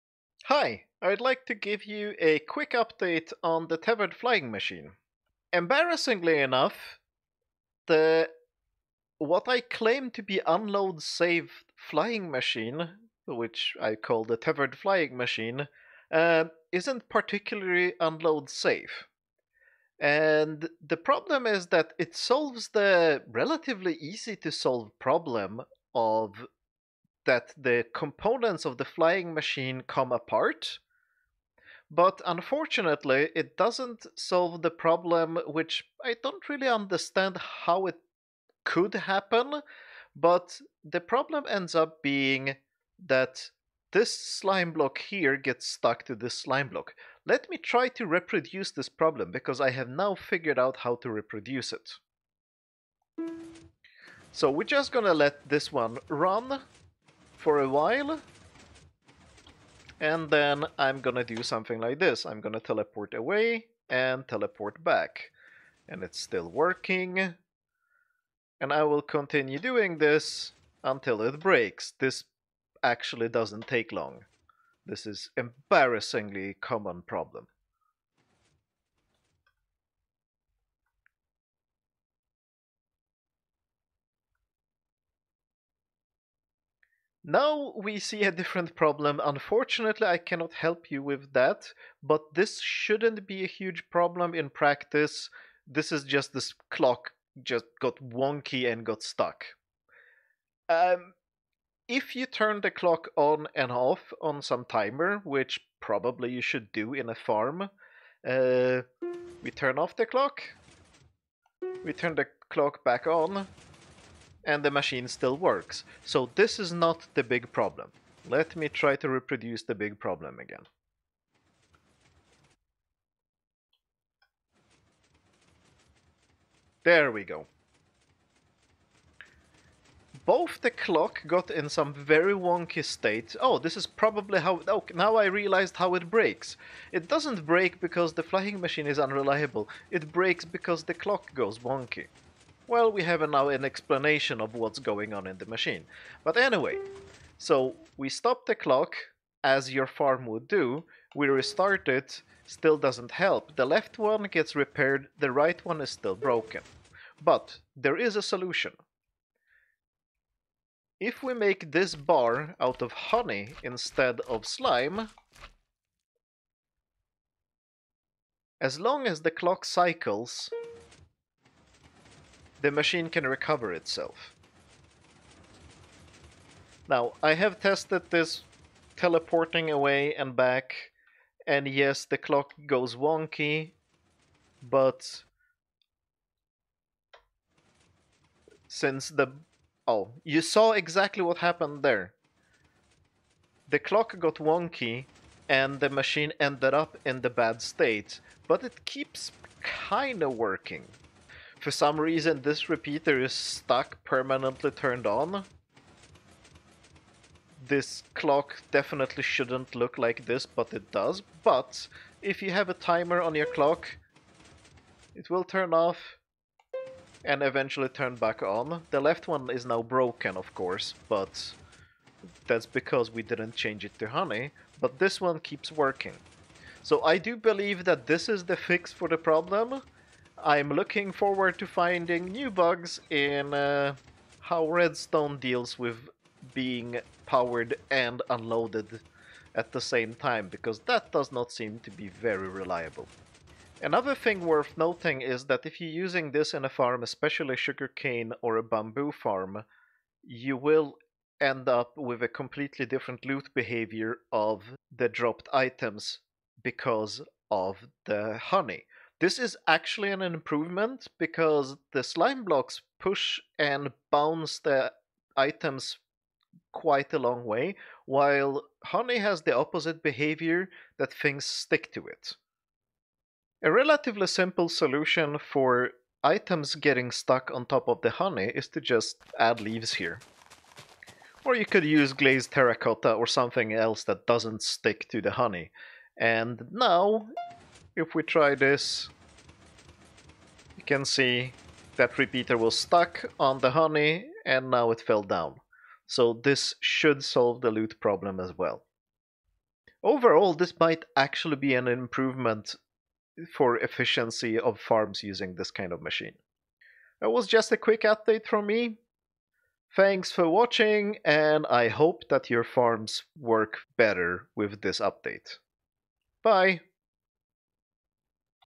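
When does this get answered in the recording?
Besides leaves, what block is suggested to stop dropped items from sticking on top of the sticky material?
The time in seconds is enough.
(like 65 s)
282 s.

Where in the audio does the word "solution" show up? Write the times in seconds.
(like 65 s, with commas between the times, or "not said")
158 s, 274 s.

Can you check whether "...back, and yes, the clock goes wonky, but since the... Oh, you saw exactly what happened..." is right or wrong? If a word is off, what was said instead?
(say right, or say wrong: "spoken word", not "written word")
right.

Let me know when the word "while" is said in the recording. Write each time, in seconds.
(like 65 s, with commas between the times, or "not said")
57 s, 268 s.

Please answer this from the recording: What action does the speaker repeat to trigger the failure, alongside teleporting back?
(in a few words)
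teleport away.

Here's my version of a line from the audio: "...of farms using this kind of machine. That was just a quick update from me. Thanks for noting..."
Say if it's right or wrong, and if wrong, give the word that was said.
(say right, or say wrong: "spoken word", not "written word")
wrong: "watching", not "noting".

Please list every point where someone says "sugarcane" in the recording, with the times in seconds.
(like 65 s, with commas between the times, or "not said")
247 s.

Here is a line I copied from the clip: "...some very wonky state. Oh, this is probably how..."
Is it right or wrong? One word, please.
right.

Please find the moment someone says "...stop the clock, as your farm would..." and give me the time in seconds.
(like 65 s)
148 s.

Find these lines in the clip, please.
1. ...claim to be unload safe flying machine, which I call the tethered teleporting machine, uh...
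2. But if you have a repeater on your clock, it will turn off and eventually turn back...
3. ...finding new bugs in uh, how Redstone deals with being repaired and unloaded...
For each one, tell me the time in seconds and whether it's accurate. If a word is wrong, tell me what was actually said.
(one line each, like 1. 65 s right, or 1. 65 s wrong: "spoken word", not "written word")
1. 9 s wrong: "flying", not "teleporting"
2. 211 s wrong: "timer", not "repeater"
3. 231 s wrong: "powered", not "repaired".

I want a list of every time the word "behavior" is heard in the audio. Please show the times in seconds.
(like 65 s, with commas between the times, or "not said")
253 s, 270 s.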